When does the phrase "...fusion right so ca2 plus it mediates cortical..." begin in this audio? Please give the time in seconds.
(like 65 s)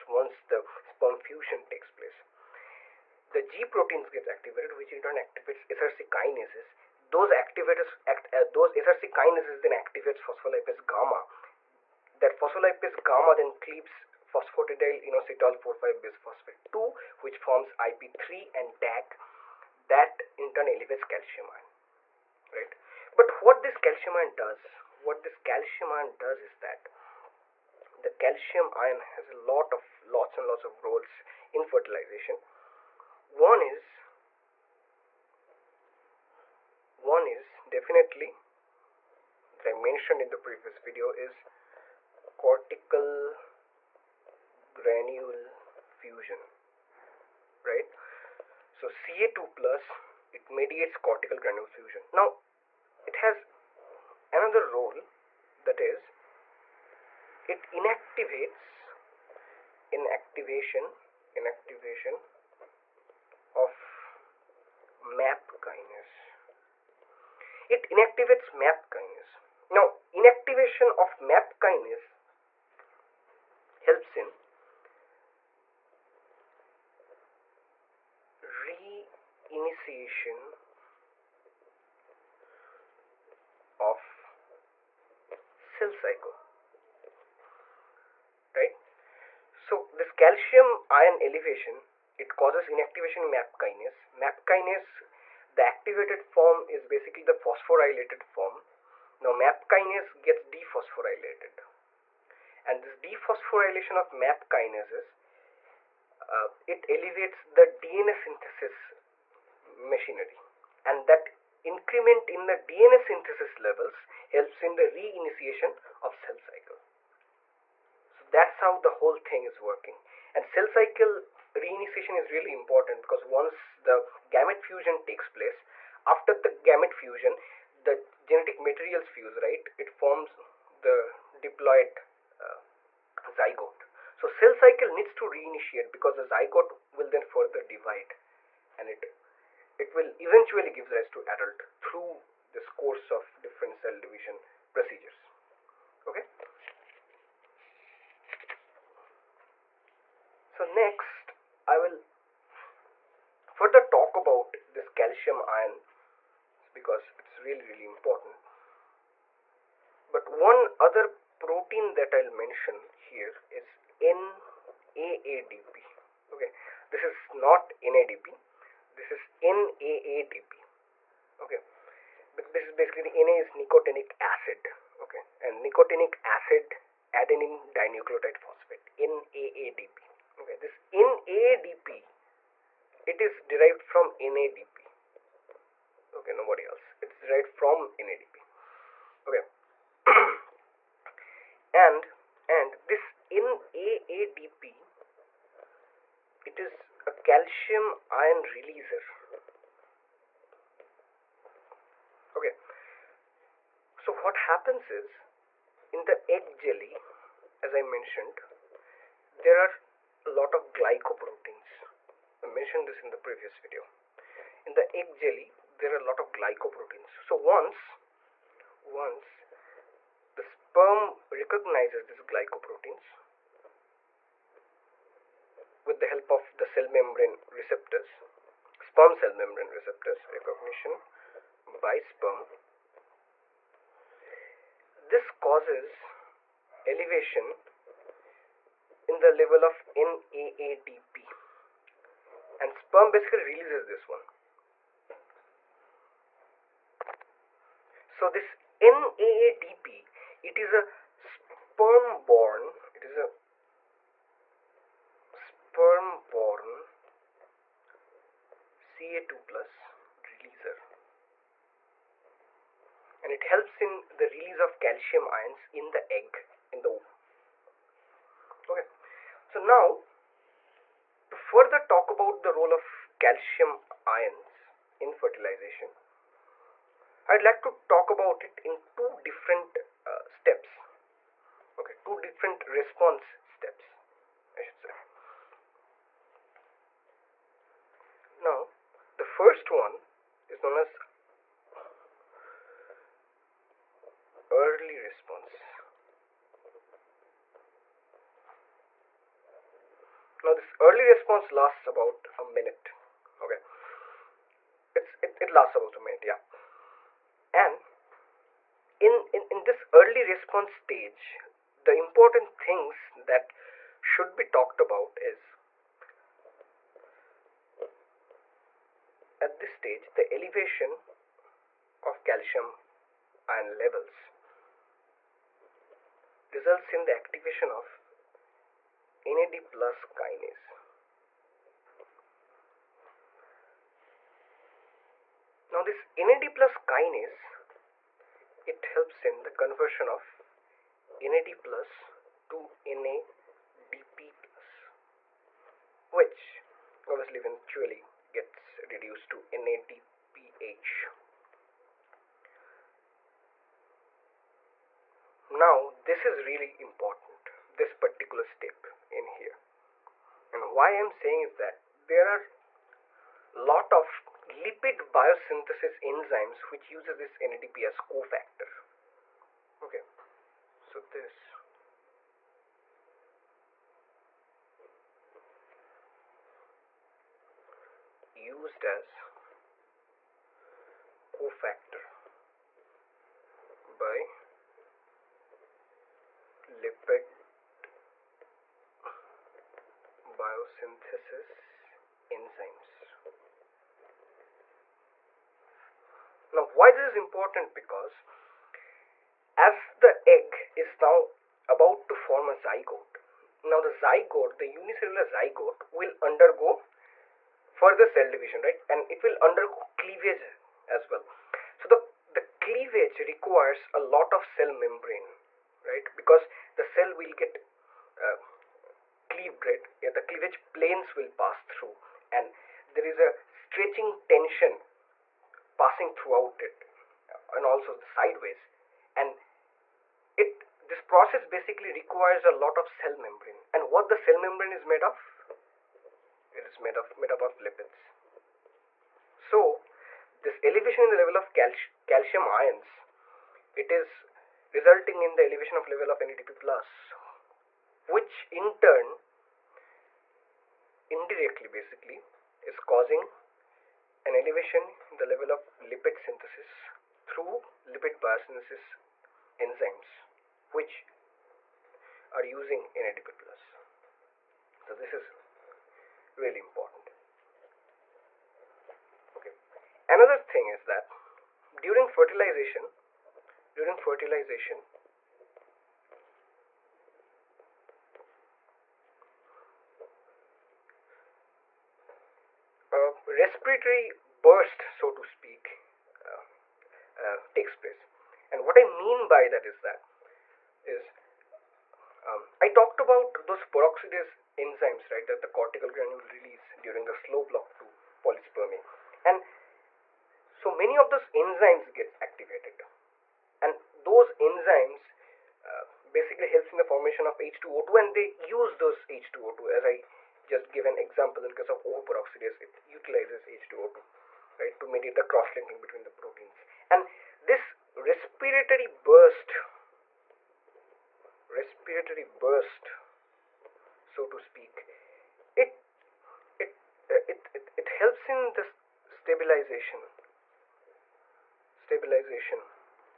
46 s.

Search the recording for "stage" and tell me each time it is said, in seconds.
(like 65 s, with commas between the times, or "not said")
310 s, 319 s.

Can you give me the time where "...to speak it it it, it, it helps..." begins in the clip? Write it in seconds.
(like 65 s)
524 s.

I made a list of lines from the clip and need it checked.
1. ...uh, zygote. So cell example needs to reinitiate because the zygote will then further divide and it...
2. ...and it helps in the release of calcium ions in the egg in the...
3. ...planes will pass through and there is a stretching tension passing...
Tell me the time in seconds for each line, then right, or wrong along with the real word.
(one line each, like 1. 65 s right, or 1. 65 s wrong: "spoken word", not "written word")
1. 132 s wrong: "cycle", not "example"
2. 263 s right
3. 420 s right.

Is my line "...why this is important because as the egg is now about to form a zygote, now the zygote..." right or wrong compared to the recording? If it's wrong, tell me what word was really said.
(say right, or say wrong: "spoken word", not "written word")
right.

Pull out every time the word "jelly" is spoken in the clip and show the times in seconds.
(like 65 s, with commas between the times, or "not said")
206 s, 215 s.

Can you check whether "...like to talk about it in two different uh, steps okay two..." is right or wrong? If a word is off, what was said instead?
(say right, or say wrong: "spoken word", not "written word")
right.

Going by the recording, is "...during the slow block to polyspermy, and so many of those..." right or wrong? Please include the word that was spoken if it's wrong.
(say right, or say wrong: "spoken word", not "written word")
right.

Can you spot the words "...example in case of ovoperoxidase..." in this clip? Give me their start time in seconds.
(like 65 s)
510 s.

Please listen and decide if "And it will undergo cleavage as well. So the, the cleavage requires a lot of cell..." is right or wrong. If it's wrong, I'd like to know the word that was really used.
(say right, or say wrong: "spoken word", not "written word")
right.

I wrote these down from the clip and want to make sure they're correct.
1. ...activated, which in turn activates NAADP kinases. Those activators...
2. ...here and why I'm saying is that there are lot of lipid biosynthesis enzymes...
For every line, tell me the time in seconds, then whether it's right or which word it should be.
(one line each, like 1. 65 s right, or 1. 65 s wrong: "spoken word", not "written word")
1. 4 s wrong: "SRC", not "NAADP"
2. 359 s right.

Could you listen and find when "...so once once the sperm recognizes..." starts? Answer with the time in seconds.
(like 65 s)
217 s.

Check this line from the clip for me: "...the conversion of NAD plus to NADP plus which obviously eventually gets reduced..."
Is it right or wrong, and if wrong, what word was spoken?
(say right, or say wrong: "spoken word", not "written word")
right.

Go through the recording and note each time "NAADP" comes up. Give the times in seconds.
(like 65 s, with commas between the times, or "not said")
164 s, 169 s, 178 s, 193 s, 239 s, 248 s.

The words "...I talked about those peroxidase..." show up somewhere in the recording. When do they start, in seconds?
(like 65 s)
492 s.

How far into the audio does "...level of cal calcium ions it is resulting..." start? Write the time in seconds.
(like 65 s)
441 s.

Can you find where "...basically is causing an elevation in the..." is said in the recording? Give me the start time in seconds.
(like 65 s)
451 s.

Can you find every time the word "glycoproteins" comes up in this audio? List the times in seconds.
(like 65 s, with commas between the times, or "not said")
210 s, 216 s, 222 s.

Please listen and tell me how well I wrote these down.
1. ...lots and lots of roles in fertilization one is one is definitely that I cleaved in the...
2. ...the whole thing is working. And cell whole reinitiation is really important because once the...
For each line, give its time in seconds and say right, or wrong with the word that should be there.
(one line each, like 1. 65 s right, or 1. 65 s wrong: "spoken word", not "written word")
1. 30 s wrong: "mentioned", not "cleaved"
2. 118 s wrong: "cycle", not "whole".